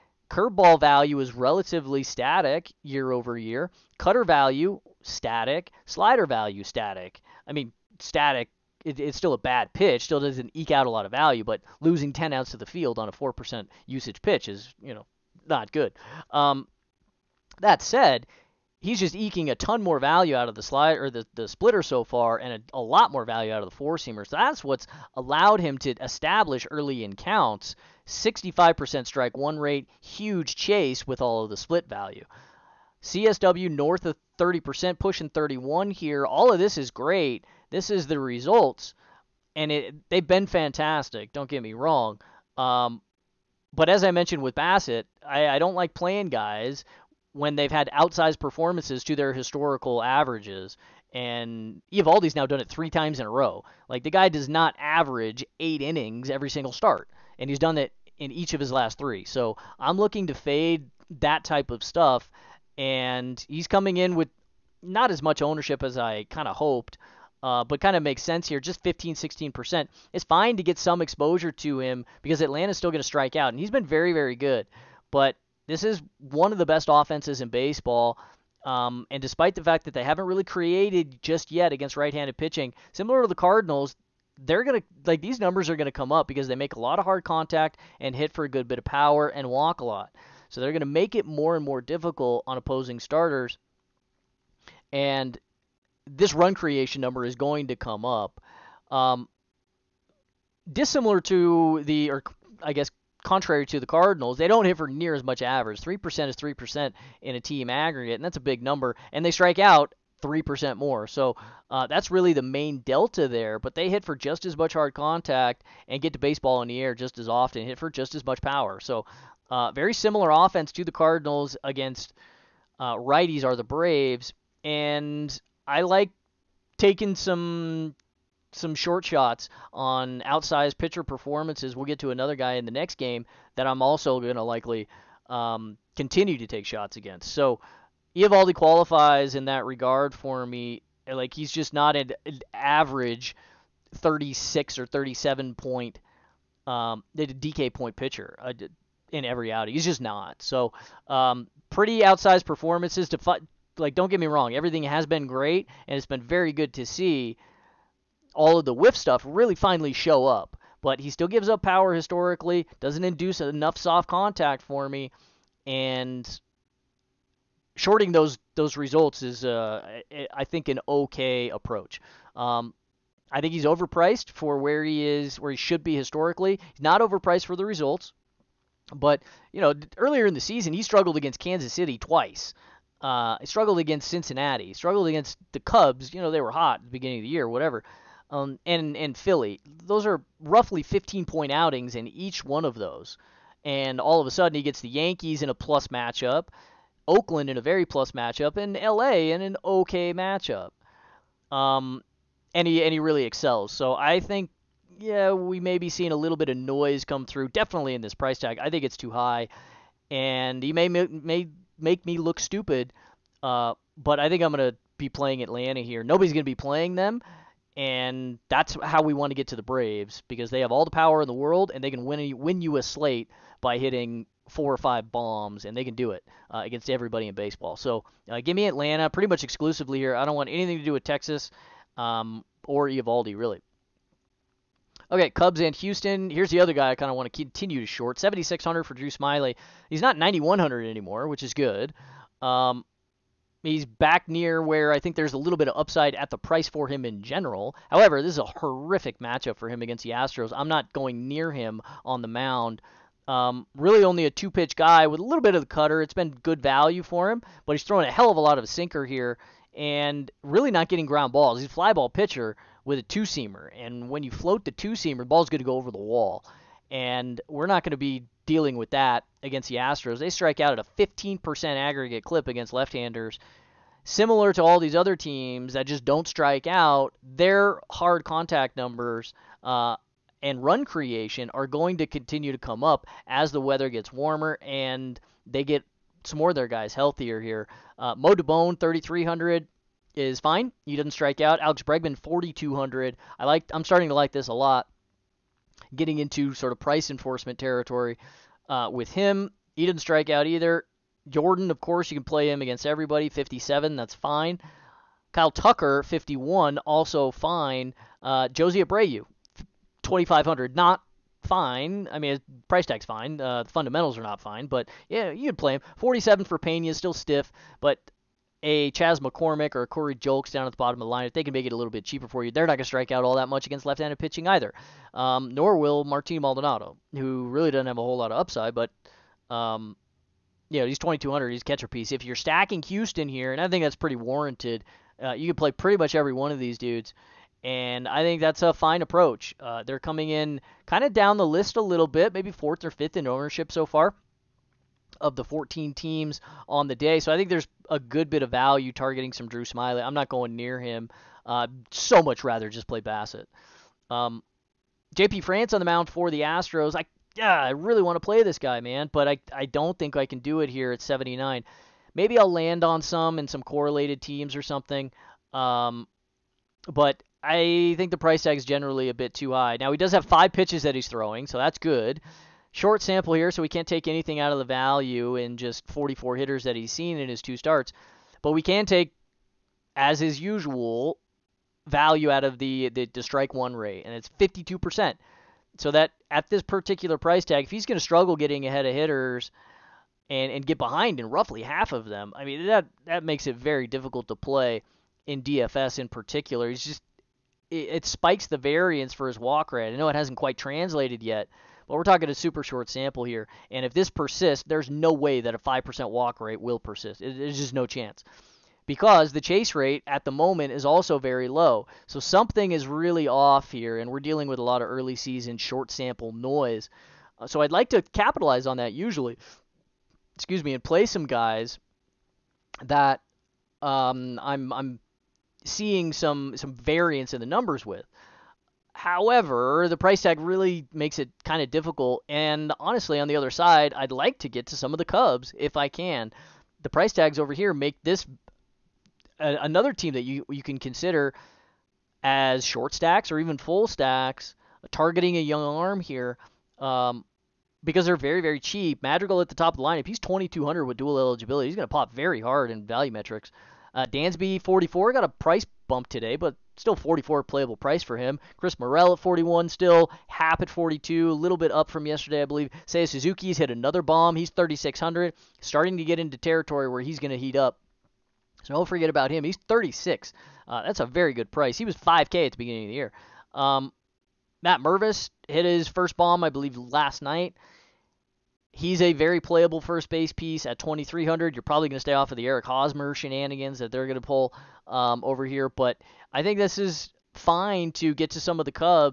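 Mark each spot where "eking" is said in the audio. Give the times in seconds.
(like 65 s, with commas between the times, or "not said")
19 s.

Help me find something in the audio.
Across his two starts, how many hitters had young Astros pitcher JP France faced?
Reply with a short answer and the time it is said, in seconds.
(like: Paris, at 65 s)
44, at 375 s.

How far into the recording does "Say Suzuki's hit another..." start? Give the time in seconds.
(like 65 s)
462 s.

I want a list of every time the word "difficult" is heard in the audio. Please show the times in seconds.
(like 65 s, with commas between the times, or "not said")
91 s, 393 s, 431 s.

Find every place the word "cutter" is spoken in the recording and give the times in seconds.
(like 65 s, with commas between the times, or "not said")
3 s, 255 s.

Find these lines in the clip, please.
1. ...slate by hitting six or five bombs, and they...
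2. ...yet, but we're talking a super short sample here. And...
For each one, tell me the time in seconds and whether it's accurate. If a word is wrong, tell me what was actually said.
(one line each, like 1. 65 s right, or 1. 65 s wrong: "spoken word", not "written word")
1. 222 s wrong: "four", not "six"
2. 401 s right.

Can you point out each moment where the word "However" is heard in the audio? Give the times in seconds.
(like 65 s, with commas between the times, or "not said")
247 s, 428 s.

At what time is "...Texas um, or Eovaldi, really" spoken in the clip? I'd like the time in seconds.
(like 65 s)
231 s.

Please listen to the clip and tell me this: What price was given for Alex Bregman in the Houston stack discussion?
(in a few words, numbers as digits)
4,200.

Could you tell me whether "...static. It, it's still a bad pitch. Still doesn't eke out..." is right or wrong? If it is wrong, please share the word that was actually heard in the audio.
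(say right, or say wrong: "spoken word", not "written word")
right.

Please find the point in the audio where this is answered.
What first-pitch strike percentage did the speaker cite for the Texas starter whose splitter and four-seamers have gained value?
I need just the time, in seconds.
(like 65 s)
28 s.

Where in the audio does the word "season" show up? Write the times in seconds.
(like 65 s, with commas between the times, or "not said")
180 s, 415 s.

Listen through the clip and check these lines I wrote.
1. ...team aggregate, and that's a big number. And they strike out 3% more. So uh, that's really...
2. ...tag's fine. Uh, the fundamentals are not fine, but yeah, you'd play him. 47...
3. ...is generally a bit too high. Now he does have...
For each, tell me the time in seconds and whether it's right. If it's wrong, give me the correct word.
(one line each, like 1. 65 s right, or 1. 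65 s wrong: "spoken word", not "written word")
1. 107 s right
2. 312 s right
3. 368 s right.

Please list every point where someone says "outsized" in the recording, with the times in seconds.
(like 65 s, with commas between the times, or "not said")
47 s, 130 s, 152 s.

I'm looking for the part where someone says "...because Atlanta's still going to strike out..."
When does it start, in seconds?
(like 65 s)
72 s.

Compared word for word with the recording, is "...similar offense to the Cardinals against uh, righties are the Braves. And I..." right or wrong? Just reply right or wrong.
right.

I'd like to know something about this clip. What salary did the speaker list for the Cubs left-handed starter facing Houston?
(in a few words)
7,600.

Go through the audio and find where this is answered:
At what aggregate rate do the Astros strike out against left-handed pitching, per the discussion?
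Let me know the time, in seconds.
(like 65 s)
270 s.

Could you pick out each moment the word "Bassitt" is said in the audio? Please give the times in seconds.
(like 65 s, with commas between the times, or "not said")
44 s, 353 s.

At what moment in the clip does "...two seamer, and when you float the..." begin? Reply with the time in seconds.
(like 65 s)
263 s.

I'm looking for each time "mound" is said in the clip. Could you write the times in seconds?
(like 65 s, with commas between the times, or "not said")
252 s, 355 s.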